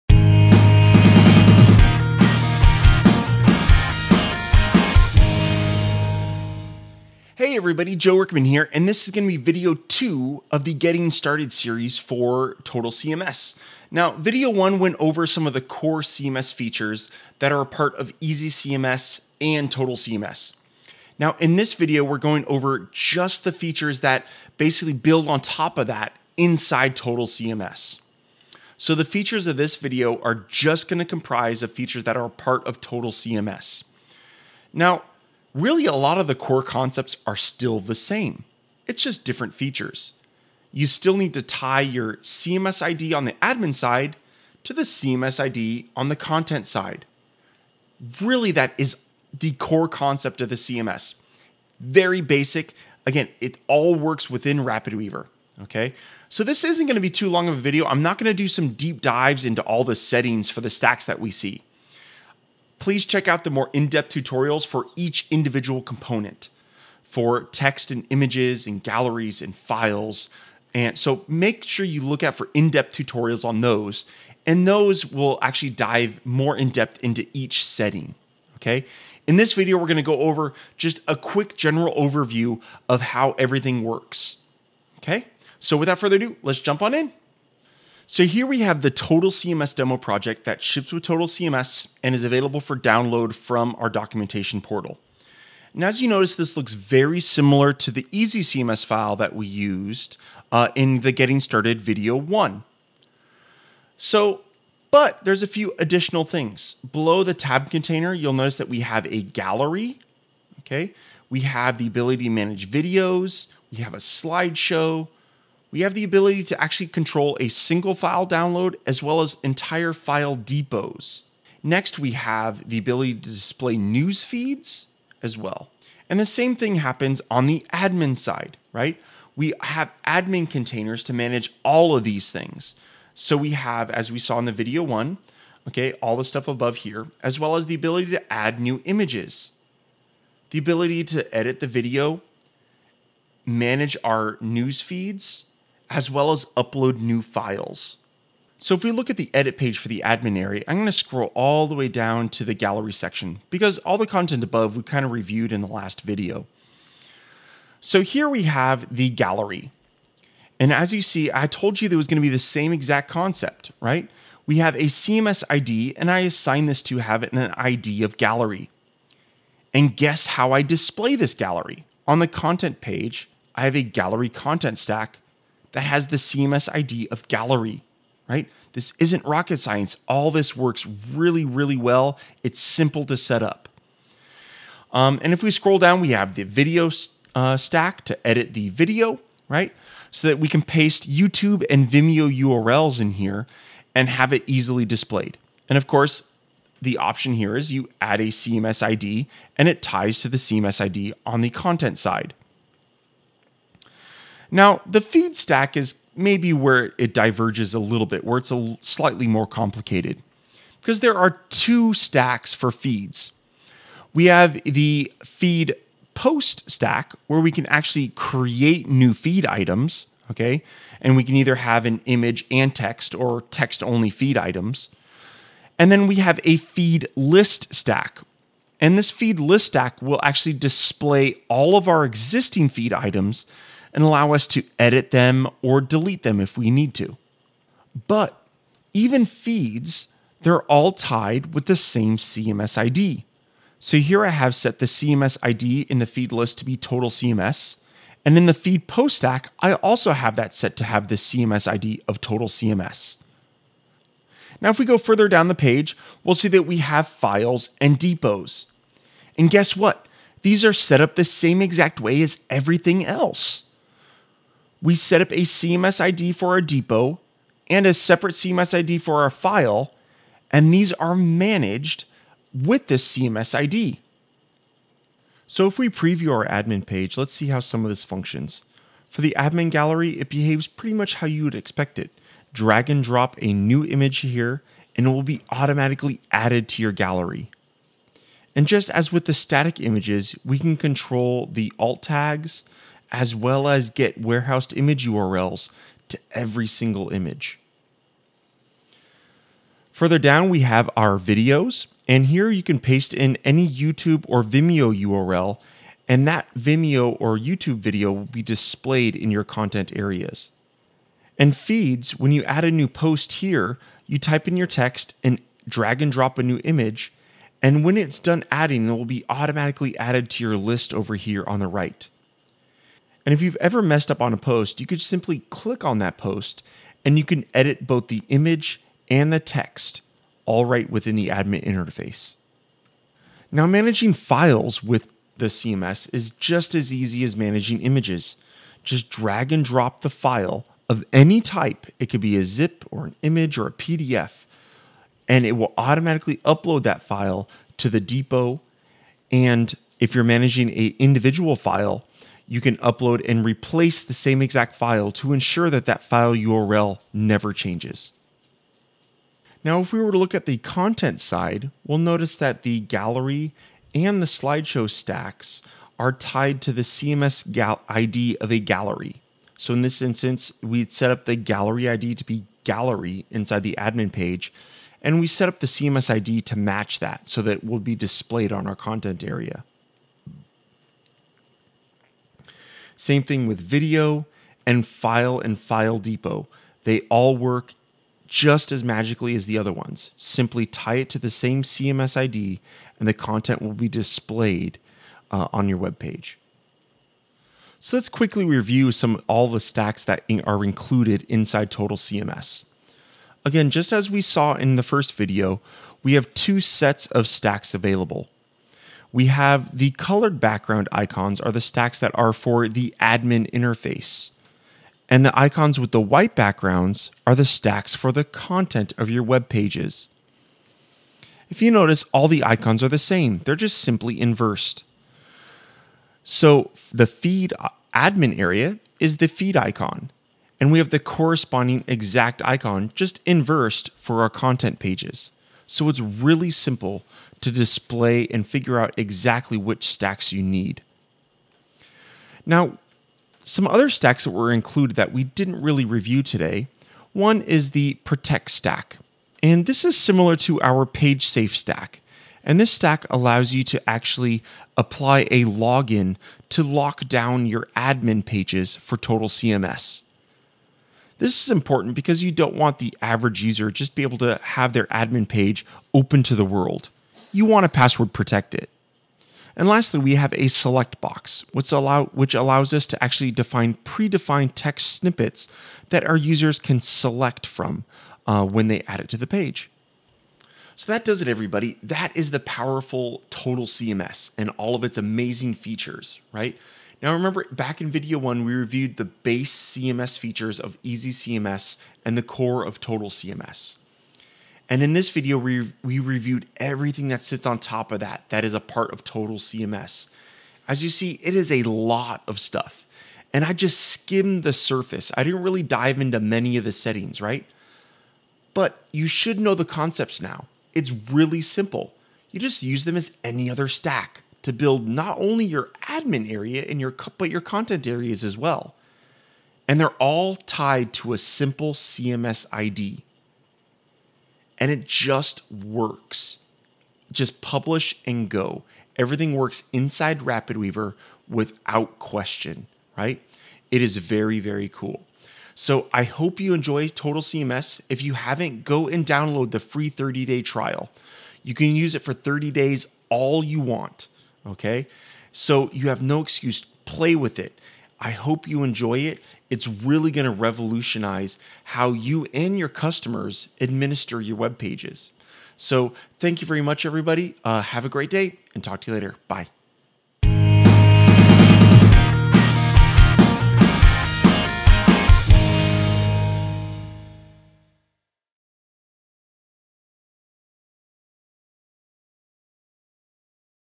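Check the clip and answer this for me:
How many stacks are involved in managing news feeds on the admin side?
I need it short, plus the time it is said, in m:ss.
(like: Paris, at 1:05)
2, at 3:31.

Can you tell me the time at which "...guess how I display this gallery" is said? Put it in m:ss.
2:49.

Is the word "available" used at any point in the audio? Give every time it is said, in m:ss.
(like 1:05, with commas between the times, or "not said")
1:32, 6:47.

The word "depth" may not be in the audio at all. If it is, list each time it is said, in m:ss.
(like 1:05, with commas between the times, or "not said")
1:03, 1:12, 1:16.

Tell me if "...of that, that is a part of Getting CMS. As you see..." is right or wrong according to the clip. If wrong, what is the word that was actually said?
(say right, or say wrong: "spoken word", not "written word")
wrong: "Total", not "Getting".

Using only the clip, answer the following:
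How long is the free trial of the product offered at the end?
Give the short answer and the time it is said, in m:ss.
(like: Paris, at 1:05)
30 days, at 8:59.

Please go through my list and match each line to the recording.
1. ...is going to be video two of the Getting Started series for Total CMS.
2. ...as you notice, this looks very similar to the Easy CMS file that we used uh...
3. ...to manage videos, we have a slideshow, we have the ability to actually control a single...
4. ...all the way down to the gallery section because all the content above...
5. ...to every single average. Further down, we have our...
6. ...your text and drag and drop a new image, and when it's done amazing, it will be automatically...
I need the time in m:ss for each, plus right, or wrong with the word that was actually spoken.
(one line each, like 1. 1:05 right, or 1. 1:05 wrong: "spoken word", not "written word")
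1. 0:09 right
2. 1:35 right
3. 1:52 right
4. 2:31 right
5. 4:56 wrong: "image", not "average"
6. 5:14 wrong: "adding", not "amazing".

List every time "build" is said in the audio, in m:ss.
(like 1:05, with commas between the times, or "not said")
0:24, 8:34.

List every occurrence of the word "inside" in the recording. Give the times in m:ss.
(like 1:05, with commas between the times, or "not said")
0:26, 6:13, 6:41, 8:49.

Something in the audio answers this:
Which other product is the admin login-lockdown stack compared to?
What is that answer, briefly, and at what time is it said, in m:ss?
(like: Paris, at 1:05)
page safe stack, at 7:30.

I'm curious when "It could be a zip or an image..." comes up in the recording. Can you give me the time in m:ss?
5:41.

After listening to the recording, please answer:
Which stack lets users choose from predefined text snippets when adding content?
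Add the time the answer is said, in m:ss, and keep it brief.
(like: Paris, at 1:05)
select box, at 7:50.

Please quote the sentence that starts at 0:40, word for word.
You still need to tie your CMS ID on the admin side to the CMS ID on the content side.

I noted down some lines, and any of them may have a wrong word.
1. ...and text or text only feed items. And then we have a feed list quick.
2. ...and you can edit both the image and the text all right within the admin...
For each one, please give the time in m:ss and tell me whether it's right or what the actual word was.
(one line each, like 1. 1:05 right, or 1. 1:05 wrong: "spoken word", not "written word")
1. 3:42 wrong: "stack", not "quick"
2. 5:27 right.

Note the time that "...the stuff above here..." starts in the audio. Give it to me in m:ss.
2:16.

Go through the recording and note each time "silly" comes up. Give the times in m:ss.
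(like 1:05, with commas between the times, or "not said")
not said.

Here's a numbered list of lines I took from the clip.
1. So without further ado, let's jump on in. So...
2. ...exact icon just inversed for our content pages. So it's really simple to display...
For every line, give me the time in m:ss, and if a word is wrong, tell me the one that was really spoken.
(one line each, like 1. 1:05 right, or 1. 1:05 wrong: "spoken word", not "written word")
1. 1:25 right
2. 7:11 right.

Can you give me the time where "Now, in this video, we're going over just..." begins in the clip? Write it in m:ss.
0:21.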